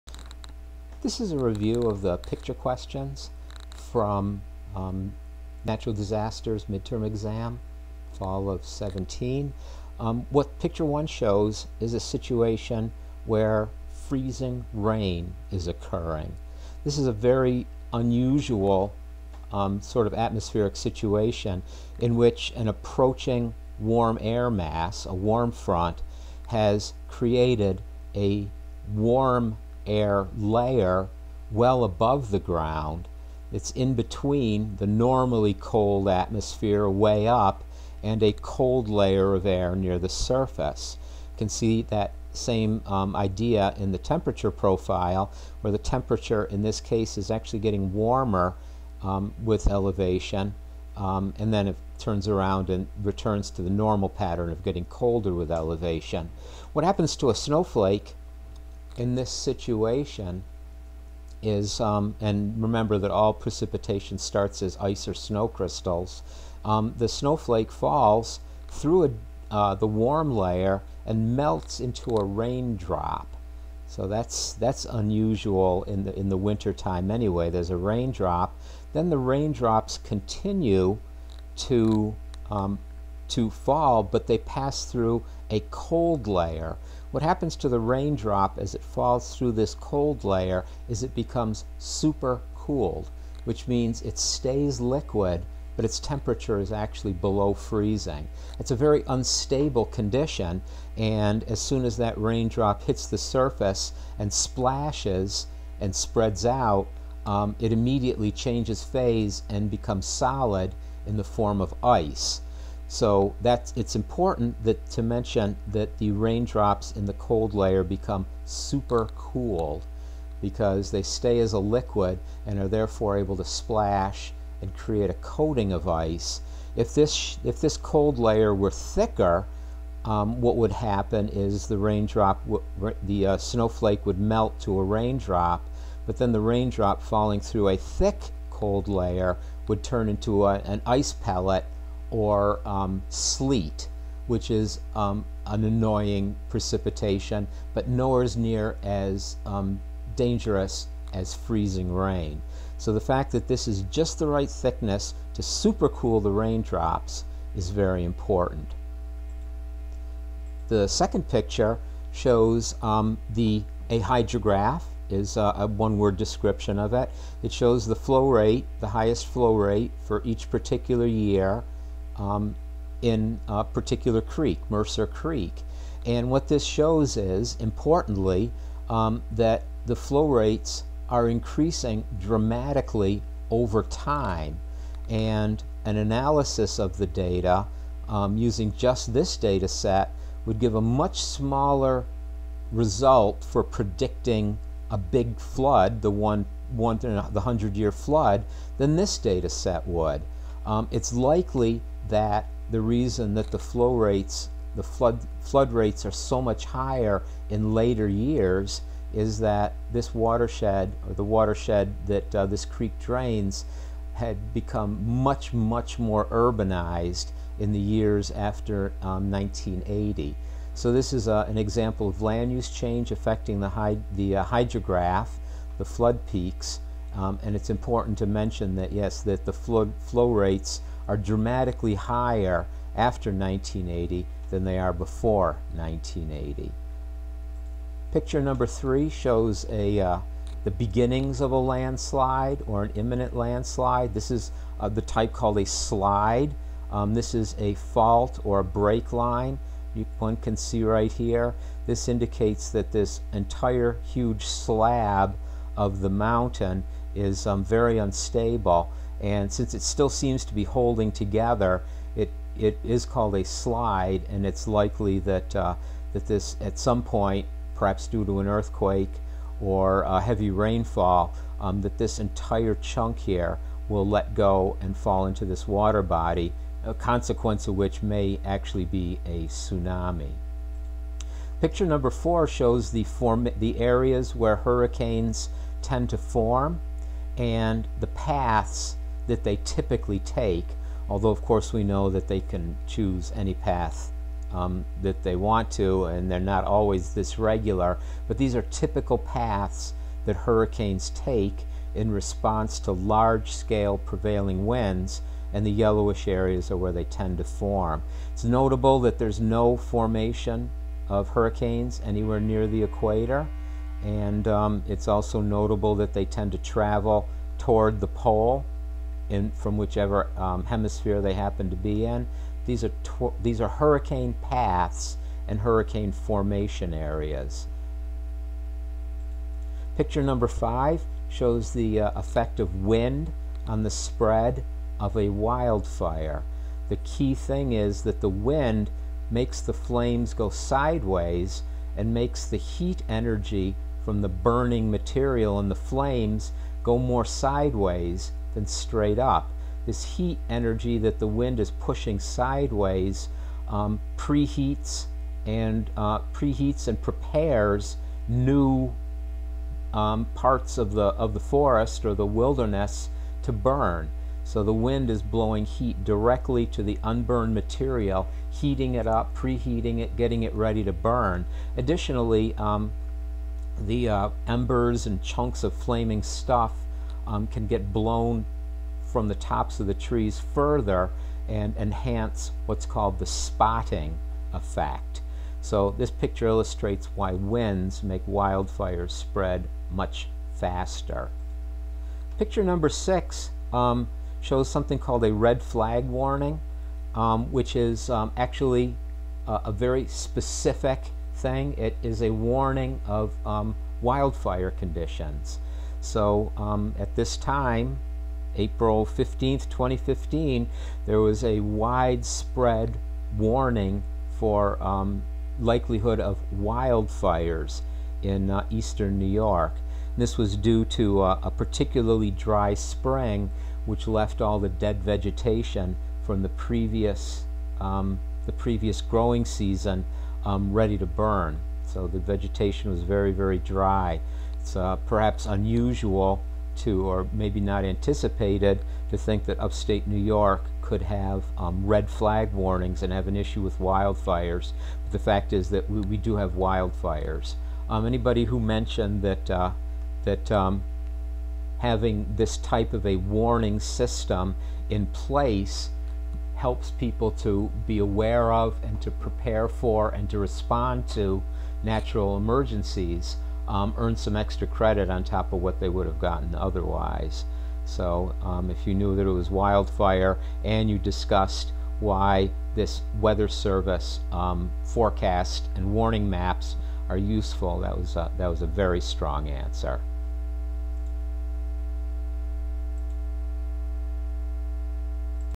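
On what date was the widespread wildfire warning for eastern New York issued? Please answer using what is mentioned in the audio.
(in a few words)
April 15th, 2015.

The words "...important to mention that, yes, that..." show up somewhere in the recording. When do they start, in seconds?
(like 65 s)
227 s.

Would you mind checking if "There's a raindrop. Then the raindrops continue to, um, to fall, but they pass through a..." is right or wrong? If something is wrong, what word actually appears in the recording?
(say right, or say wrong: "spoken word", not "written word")
right.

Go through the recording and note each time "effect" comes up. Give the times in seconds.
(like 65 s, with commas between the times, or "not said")
332 s, 384 s.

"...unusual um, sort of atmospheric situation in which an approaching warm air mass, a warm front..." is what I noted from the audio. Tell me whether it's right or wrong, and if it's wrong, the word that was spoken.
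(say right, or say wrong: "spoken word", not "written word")
right.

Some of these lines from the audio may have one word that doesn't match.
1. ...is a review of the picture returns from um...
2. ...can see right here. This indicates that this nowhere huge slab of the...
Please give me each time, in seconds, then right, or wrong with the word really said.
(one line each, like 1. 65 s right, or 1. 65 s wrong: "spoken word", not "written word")
1. 1 s wrong: "questions", not "returns"
2. 250 s wrong: "entire", not "nowhere".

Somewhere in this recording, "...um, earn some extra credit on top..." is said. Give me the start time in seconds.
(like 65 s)
463 s.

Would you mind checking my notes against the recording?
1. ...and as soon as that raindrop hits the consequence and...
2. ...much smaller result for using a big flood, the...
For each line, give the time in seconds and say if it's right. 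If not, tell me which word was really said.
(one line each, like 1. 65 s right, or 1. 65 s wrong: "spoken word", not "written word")
1. 100 s wrong: "surface", not "consequence"
2. 190 s wrong: "predicting", not "using".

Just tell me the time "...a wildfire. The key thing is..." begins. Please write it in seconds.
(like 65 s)
335 s.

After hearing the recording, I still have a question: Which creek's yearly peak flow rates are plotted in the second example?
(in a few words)
Mercer Creek.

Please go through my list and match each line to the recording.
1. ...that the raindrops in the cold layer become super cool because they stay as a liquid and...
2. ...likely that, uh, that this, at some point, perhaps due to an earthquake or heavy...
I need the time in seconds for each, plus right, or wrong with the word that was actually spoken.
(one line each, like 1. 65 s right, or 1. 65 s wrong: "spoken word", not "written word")
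1. 115 s right
2. 264 s right.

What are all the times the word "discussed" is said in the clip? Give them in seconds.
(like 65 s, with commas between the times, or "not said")
470 s.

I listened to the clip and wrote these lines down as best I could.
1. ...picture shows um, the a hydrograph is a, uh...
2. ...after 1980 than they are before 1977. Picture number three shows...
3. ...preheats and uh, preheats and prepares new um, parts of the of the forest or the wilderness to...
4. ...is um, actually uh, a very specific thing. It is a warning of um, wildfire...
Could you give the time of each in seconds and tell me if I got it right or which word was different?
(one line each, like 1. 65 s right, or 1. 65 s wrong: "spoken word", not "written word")
1. 161 s right
2. 232 s wrong: "1980", not "1977"
3. 354 s right
4. 397 s right.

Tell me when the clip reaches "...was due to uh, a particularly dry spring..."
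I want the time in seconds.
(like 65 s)
420 s.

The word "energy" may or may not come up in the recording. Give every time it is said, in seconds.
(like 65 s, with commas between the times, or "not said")
343 s, 350 s.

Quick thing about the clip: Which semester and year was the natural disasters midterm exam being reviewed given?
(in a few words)
fall of 17.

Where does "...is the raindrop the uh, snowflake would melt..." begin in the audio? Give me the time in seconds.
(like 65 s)
131 s.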